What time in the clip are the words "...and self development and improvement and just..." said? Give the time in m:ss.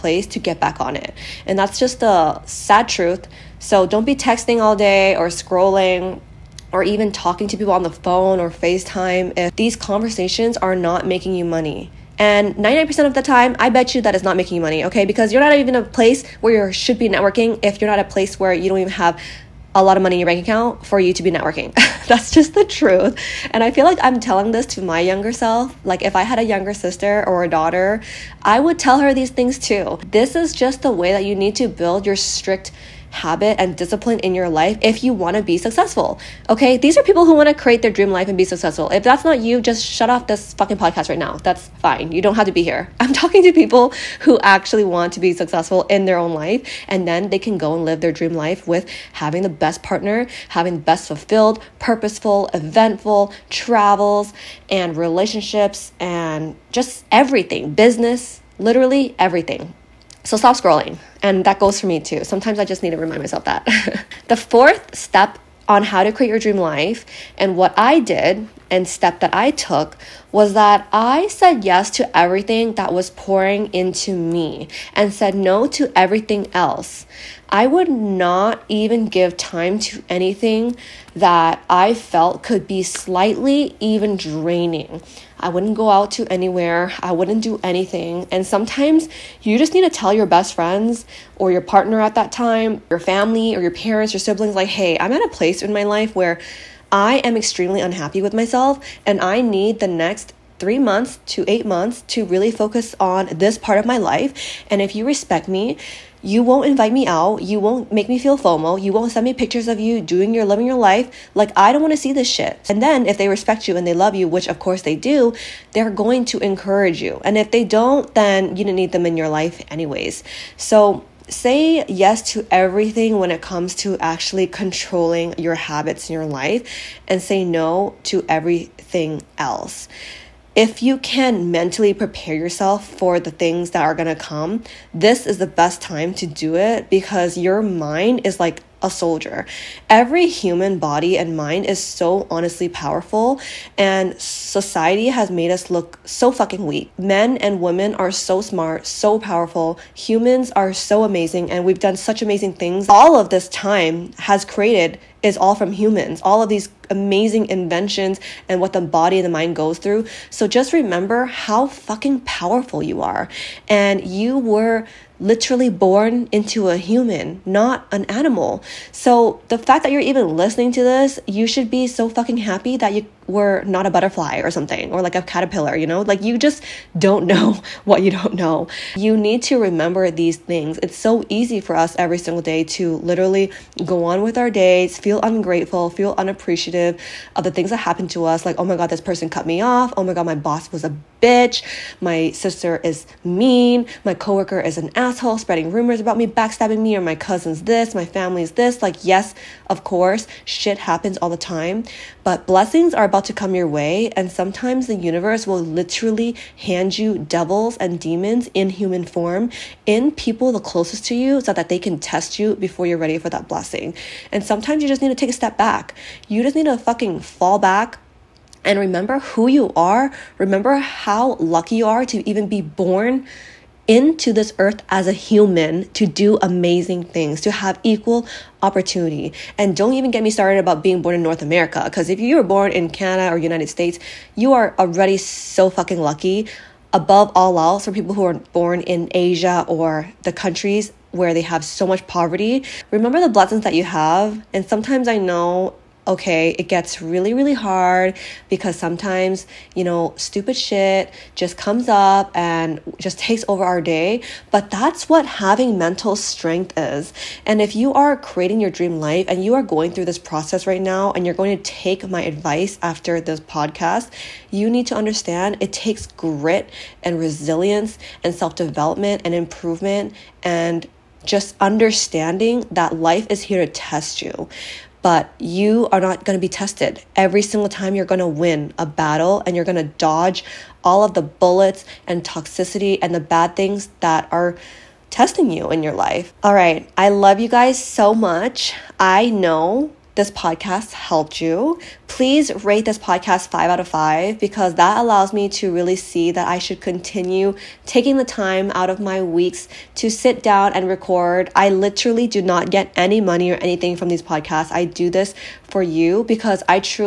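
4:28.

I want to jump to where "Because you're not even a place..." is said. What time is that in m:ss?
0:15.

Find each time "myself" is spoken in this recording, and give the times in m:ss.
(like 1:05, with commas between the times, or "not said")
1:03, 1:38.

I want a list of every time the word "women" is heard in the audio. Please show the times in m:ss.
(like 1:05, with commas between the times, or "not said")
2:27.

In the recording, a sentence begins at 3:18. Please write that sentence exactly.
Like, yes, of course, shit happens all the time.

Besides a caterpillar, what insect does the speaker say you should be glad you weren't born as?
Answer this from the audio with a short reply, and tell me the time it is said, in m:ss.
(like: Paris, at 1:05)
butterfly, at 2:53.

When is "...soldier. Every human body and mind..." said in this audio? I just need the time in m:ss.
2:18.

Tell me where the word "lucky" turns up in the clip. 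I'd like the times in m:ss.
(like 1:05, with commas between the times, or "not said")
3:41, 3:55.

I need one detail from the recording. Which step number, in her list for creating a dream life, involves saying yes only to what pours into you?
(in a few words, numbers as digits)
fourth.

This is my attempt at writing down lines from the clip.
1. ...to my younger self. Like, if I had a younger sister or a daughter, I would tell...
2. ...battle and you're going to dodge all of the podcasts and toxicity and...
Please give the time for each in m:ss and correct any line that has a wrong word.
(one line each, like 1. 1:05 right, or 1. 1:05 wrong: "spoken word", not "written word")
1. 0:24 right
2. 4:38 wrong: "bullets", not "podcasts".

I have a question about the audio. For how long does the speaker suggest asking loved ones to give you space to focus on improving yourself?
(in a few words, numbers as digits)
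3 to 8 months.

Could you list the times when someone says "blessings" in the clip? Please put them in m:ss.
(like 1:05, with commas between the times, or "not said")
3:22, 3:33, 4:03.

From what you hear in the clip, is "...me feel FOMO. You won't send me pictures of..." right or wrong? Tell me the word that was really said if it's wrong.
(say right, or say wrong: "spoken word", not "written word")
right.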